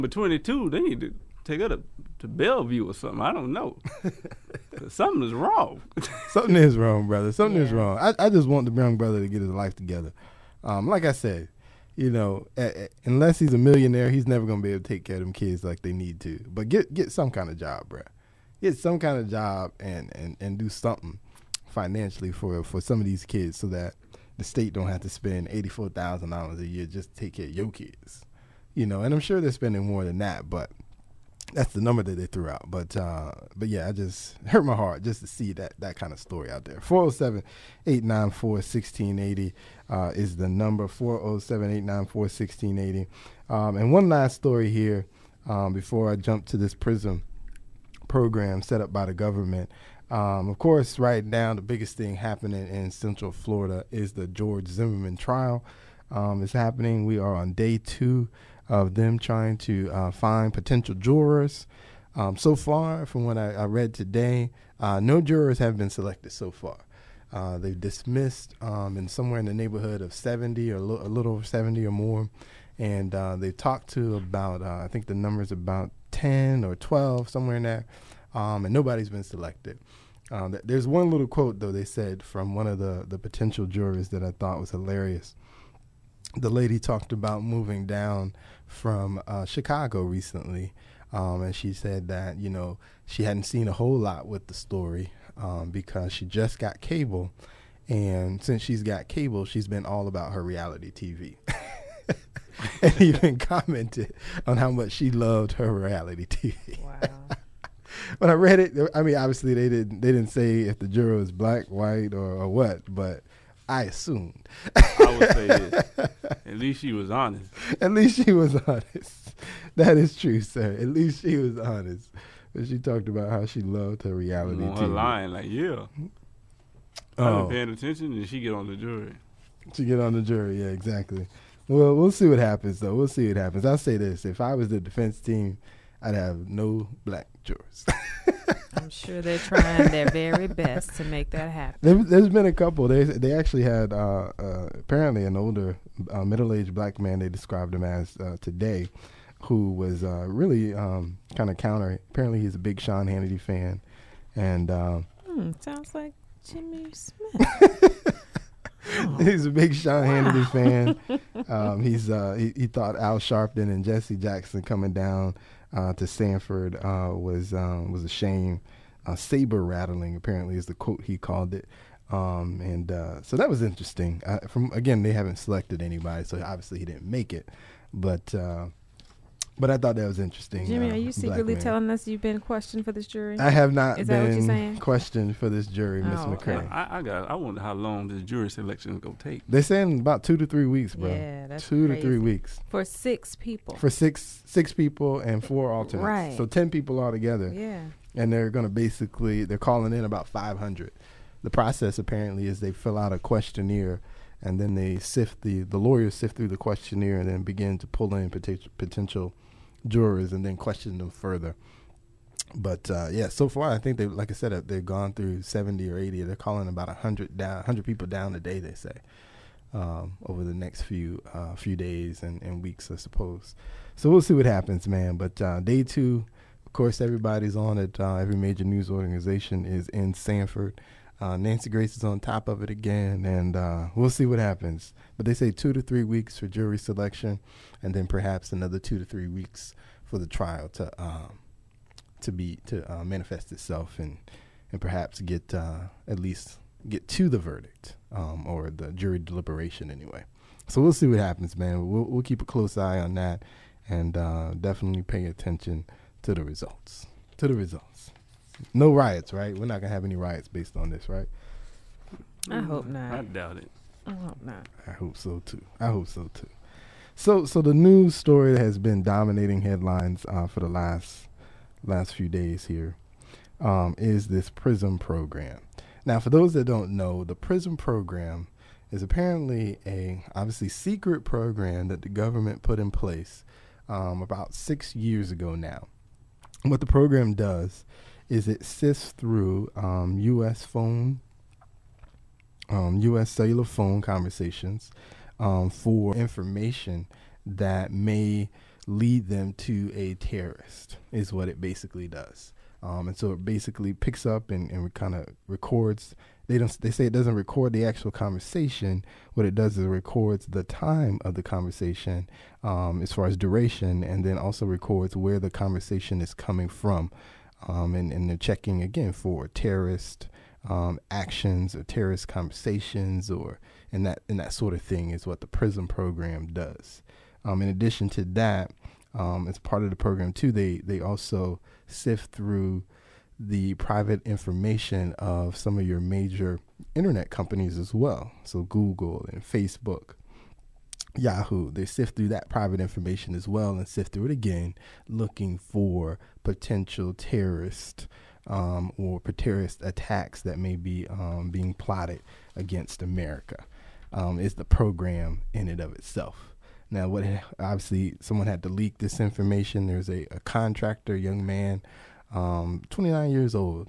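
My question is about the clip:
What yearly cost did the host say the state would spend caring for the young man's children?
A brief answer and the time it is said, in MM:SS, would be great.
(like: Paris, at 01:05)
$84,000, at 00:25.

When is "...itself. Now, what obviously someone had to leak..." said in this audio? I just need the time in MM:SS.
05:55.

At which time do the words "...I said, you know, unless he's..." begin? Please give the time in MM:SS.
00:11.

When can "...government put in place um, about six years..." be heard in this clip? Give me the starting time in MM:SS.
04:42.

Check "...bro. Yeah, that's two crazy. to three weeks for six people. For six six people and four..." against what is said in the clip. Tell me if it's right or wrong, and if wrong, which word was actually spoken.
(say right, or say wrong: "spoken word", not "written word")
right.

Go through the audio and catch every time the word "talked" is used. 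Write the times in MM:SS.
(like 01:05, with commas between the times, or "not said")
01:13, 01:26, 02:02.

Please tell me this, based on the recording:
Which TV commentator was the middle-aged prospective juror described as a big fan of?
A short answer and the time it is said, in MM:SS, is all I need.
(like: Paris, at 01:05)
Sean Hannity, at 02:32.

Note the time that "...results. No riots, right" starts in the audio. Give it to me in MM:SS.
04:17.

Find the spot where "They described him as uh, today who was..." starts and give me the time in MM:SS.
02:27.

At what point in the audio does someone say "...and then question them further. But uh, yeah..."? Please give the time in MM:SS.
03:30.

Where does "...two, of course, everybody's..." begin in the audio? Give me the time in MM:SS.
03:45.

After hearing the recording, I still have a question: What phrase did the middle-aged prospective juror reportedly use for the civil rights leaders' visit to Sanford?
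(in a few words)
saber rattling.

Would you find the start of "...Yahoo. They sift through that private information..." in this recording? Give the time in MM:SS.
05:41.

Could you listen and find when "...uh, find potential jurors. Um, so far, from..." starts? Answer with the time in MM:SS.
00:59.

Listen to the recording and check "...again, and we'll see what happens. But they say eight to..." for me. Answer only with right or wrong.
wrong.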